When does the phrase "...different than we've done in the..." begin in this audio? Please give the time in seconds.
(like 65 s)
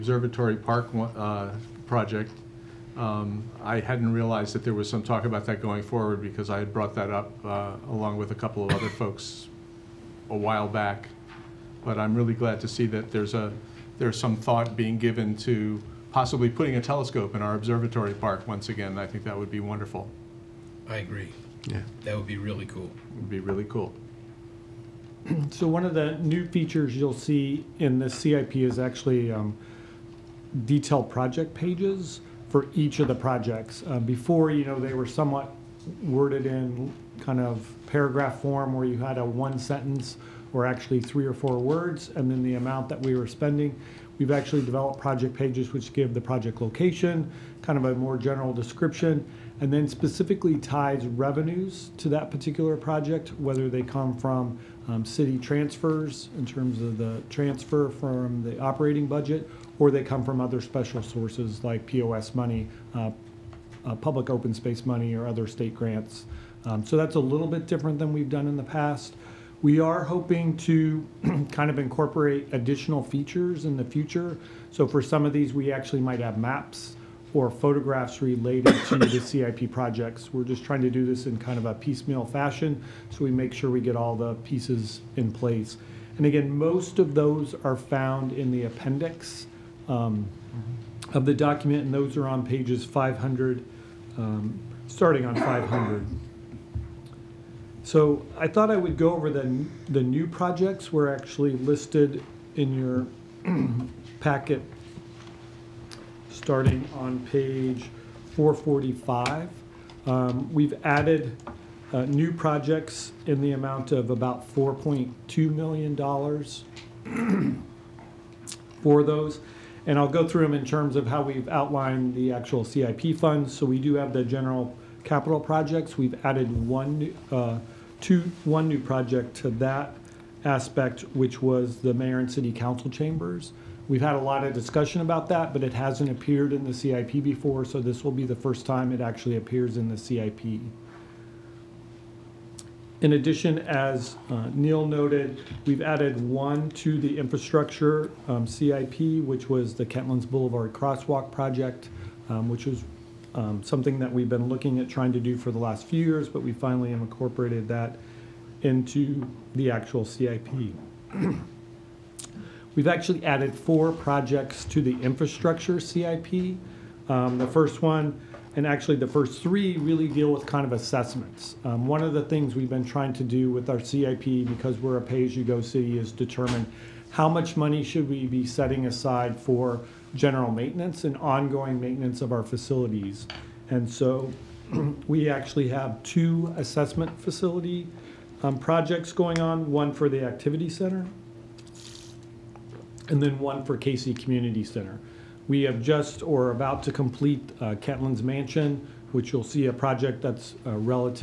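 67 s.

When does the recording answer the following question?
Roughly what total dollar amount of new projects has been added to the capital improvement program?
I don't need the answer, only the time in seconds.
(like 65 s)
114 s.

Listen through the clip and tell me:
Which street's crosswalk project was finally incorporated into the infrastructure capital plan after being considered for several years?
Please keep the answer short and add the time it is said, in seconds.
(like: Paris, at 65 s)
Kentlands Boulevard, at 149 s.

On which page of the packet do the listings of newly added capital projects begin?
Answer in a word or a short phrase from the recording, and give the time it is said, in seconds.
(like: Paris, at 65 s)
445, at 108 s.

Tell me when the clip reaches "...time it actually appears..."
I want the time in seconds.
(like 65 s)
138 s.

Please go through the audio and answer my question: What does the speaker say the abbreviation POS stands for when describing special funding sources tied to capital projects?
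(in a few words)
public open space.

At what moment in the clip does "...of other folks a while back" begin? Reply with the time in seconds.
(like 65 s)
8 s.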